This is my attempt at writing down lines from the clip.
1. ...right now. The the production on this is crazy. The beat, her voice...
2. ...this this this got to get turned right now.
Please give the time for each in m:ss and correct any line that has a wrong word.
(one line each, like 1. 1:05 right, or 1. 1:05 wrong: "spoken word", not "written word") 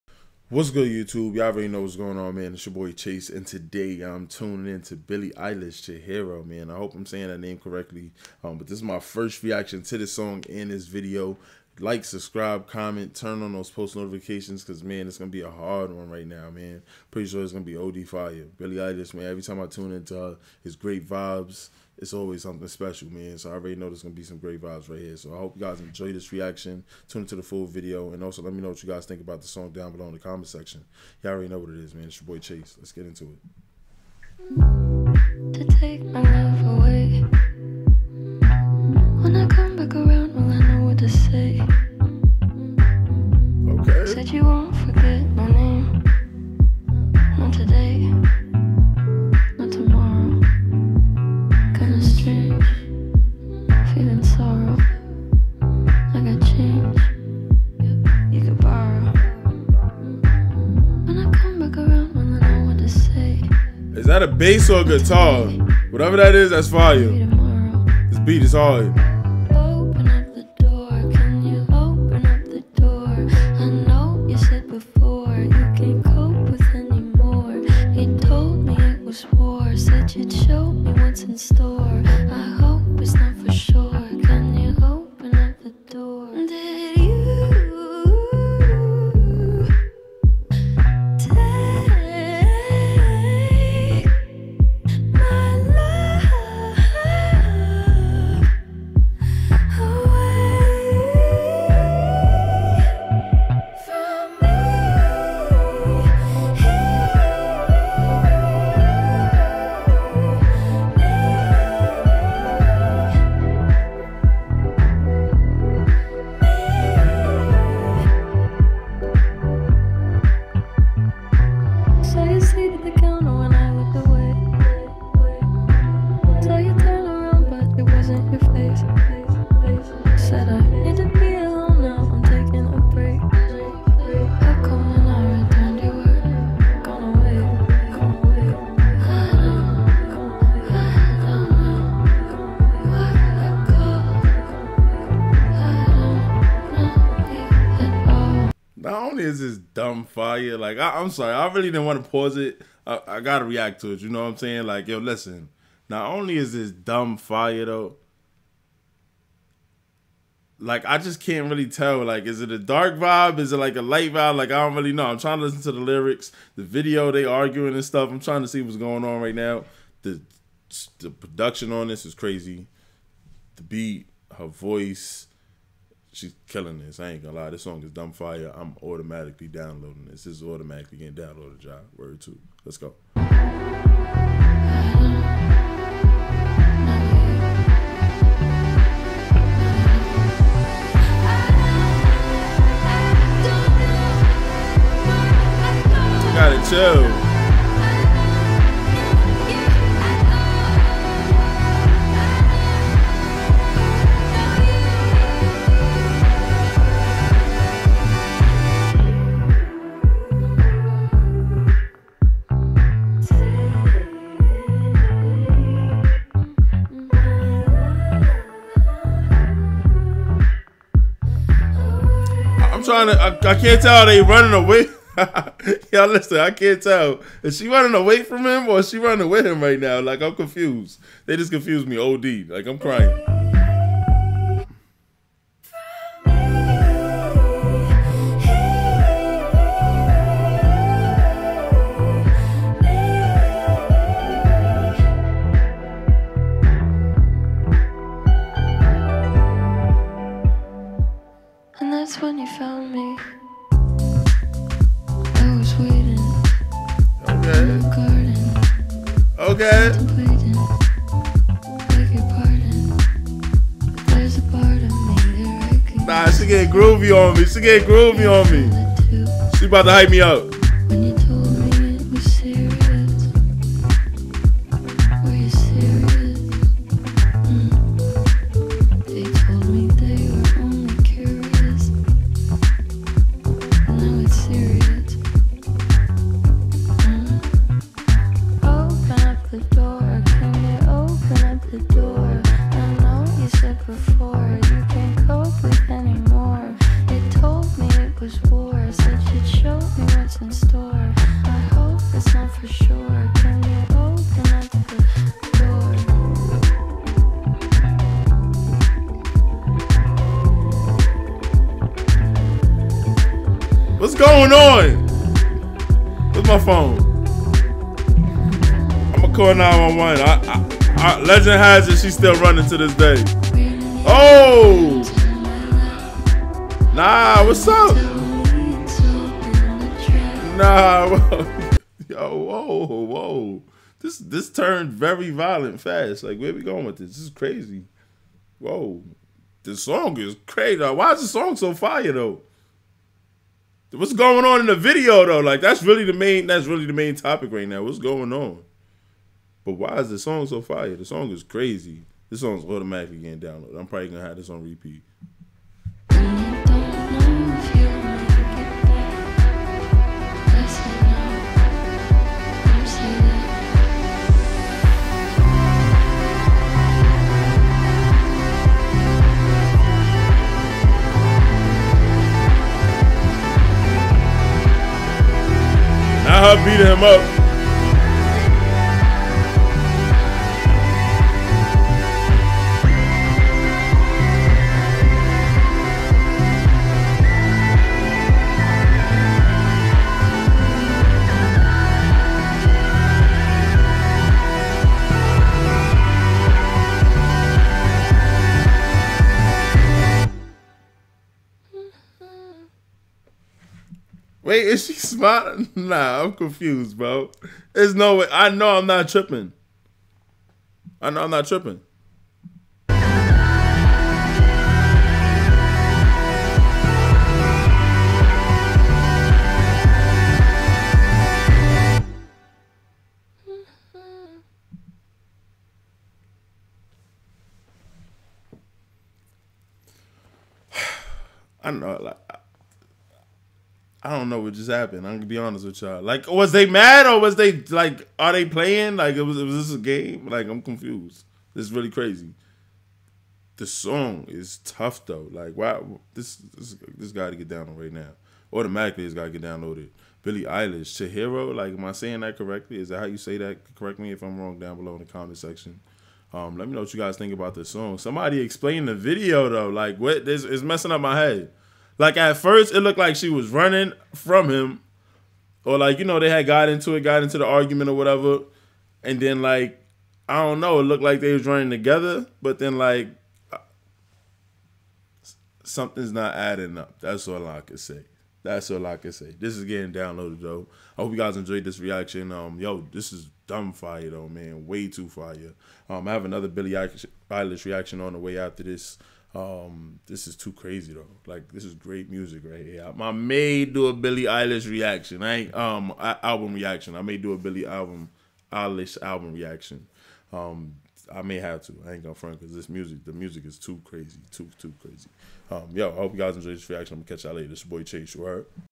1. 2:49 right
2. 7:26 wrong: "downloaded", not "turned".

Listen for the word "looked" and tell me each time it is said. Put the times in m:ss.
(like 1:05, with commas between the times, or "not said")
7:42, 7:50.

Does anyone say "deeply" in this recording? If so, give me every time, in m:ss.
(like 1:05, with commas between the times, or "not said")
not said.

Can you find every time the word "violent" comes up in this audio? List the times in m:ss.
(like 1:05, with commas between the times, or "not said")
5:35.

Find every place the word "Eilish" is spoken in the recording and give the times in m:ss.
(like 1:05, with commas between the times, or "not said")
0:05, 0:18, 7:30, 8:06, 8:14, 8:18.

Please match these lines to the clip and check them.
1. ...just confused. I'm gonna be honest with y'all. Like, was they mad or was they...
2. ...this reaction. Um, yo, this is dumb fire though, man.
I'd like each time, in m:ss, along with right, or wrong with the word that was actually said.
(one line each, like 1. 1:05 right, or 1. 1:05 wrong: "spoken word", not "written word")
1. 7:14 wrong: "happened", not "confused"
2. 8:01 right.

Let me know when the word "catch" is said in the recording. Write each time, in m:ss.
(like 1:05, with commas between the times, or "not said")
8:27.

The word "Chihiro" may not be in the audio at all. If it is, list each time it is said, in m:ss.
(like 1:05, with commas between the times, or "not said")
0:05, 7:30.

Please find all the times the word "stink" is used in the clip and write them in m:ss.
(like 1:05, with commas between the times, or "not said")
not said.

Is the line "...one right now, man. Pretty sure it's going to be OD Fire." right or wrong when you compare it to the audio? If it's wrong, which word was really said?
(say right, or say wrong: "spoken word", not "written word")
right.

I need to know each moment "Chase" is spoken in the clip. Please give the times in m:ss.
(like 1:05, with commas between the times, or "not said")
0:02, 0:32, 8:27.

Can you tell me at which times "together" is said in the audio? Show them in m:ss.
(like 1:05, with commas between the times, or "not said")
7:51.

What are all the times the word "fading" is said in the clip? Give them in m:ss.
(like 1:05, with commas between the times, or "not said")
not said.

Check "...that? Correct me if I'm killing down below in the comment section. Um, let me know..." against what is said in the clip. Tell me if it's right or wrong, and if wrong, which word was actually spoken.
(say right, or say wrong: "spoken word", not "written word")
wrong: "wrong", not "killing".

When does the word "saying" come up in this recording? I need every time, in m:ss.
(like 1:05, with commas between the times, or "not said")
0:07, 2:34, 7:31.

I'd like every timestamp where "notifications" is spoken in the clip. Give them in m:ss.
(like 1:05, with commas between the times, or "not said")
0:13.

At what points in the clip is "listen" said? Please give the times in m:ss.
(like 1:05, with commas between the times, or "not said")
2:34, 2:45, 3:46.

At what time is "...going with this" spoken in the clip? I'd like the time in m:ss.
5:36.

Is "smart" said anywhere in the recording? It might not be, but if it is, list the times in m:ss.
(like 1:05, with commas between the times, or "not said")
6:44.